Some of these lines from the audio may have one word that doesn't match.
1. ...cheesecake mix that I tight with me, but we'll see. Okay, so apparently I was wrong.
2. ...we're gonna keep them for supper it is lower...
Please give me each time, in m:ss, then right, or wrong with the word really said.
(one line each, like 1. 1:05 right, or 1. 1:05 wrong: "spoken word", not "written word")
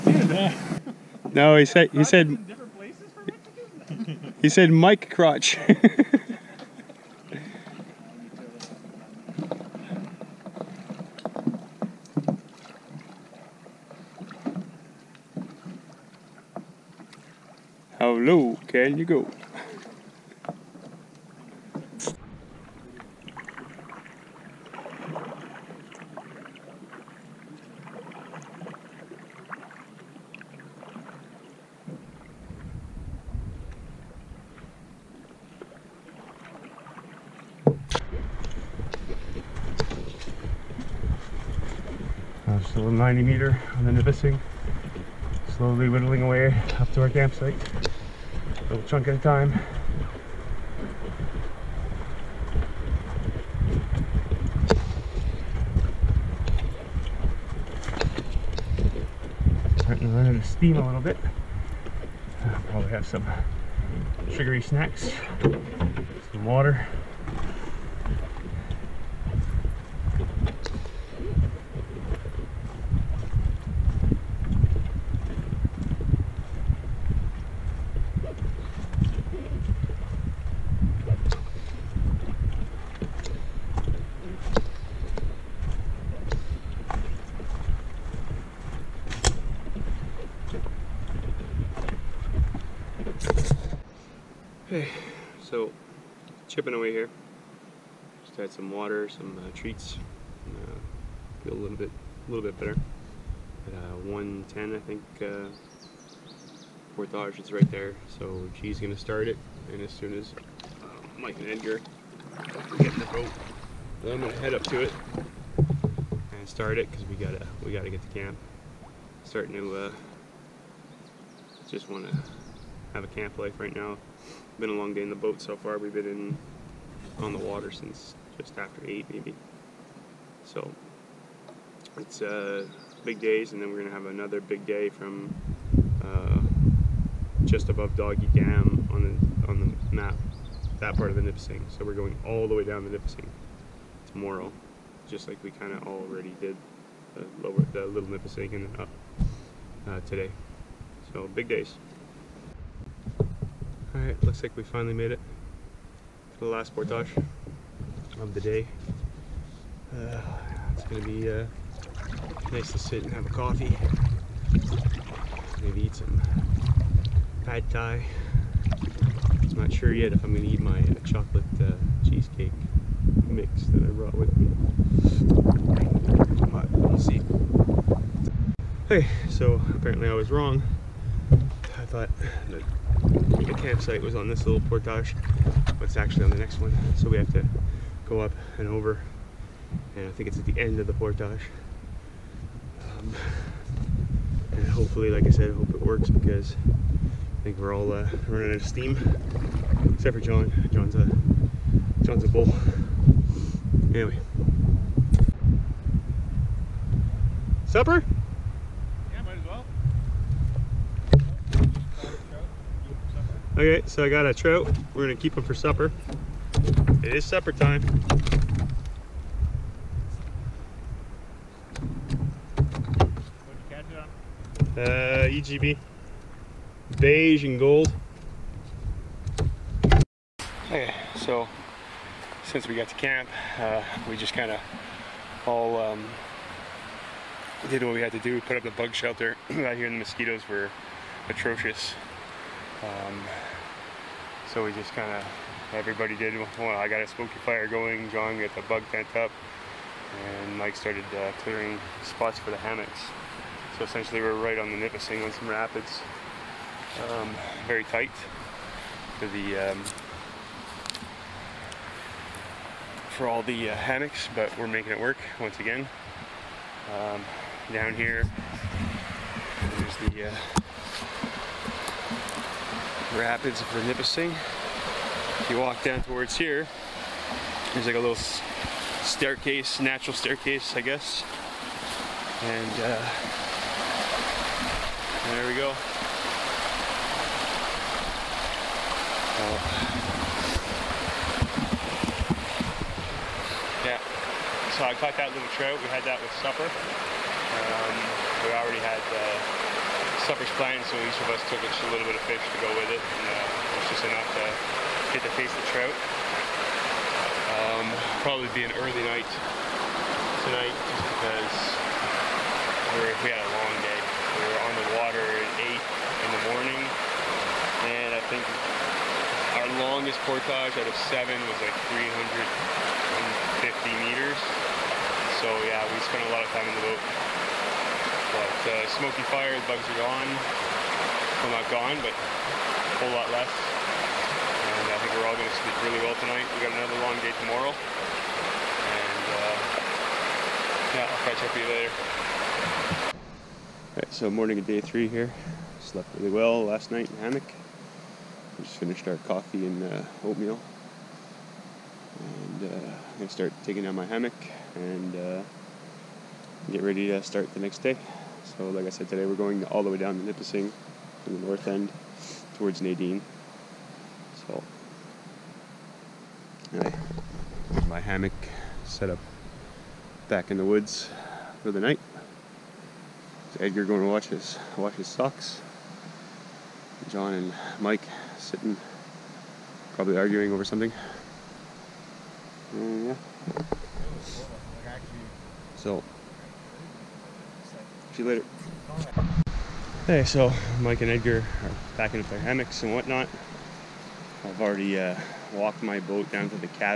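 1. 2:52 wrong: "brought", not "tight"
2. 3:34 wrong: "supper", not "lower".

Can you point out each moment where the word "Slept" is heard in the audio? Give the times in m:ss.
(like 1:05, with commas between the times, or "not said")
5:45.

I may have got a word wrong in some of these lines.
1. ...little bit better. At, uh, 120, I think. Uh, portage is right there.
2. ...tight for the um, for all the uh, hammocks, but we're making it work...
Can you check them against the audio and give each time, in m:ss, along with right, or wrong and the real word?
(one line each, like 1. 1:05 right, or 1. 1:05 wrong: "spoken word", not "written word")
1. 1:42 wrong: "110", not "120"
2. 4:17 right.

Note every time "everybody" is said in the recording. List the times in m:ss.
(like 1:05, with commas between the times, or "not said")
4:05.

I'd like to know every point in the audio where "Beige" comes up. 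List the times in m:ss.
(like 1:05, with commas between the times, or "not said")
3:46.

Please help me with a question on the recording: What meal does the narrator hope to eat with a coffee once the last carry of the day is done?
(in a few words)
pad thai.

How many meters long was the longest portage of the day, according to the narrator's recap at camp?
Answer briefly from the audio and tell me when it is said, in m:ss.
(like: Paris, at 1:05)
350, at 5:21.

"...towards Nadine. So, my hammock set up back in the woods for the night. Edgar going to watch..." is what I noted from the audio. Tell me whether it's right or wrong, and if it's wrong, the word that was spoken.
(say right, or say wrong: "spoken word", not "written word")
right.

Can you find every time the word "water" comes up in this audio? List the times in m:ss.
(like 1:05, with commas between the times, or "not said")
1:06, 1:38, 2:07, 5:15.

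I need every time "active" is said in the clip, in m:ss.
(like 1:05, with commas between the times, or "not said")
not said.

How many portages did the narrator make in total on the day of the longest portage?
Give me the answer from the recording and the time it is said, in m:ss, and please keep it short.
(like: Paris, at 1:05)
7, at 5:21.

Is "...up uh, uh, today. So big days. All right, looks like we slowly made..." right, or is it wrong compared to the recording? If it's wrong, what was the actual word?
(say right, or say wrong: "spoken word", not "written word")
wrong: "finally", not "slowly".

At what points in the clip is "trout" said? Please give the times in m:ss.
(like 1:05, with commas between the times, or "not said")
3:34, 4:55, 5:05.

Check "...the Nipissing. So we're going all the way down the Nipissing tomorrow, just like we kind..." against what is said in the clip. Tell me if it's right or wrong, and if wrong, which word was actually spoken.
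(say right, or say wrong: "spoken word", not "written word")
right.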